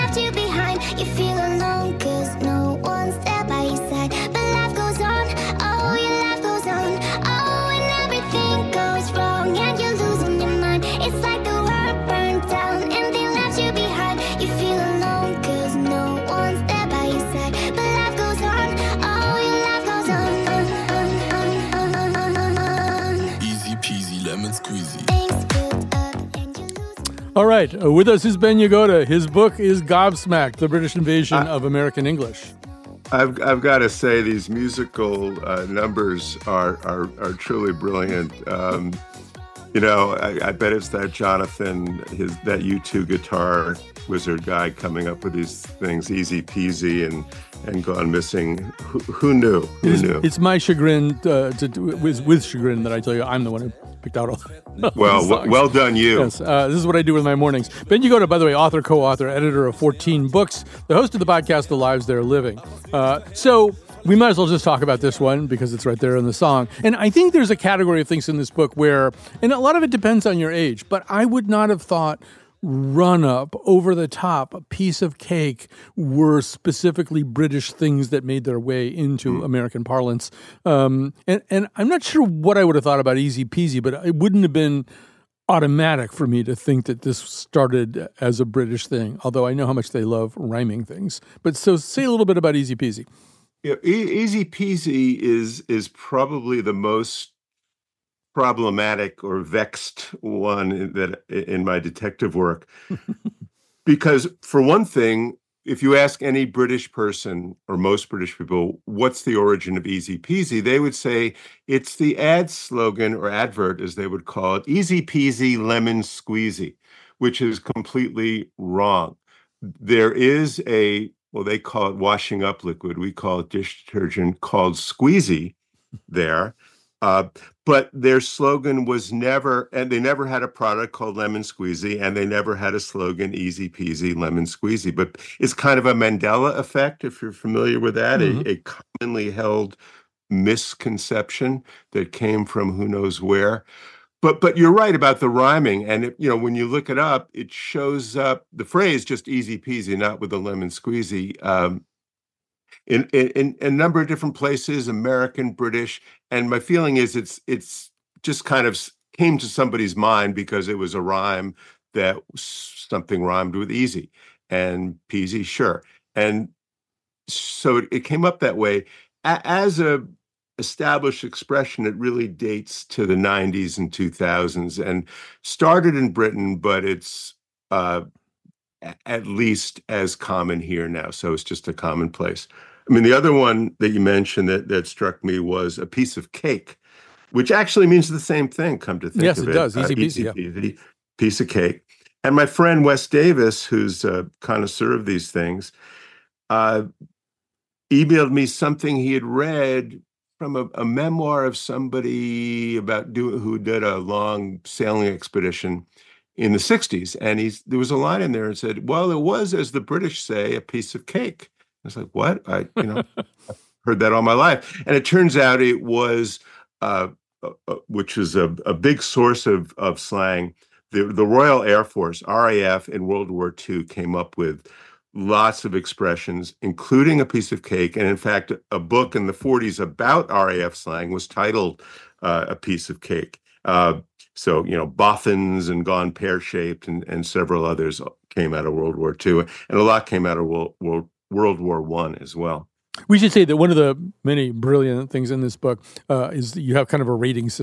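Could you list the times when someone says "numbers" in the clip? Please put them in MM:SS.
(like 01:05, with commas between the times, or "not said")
00:35, 02:33.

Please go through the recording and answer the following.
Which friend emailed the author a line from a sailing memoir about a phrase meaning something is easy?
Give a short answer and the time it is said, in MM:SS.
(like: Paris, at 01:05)
Wes Davis, at 03:12.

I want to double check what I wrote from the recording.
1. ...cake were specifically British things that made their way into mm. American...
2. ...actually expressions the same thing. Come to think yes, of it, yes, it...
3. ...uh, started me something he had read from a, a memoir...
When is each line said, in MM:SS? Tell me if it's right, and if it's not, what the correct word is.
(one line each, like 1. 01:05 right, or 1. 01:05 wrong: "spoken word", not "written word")
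1. 01:15 right
2. 03:07 wrong: "means", not "expressions"
3. 03:16 wrong: "emailed", not "started".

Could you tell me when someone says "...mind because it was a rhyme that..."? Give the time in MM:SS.
02:39.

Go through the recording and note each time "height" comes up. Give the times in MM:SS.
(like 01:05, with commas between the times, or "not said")
not said.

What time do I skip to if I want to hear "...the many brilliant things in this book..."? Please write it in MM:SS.
04:03.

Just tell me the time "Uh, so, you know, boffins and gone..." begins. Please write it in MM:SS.
03:53.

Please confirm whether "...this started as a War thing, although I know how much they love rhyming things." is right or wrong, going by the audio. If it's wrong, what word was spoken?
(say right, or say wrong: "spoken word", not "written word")
wrong: "British", not "War".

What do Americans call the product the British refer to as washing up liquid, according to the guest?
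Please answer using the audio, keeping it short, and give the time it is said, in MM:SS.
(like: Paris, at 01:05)
dish detergent, at 02:03.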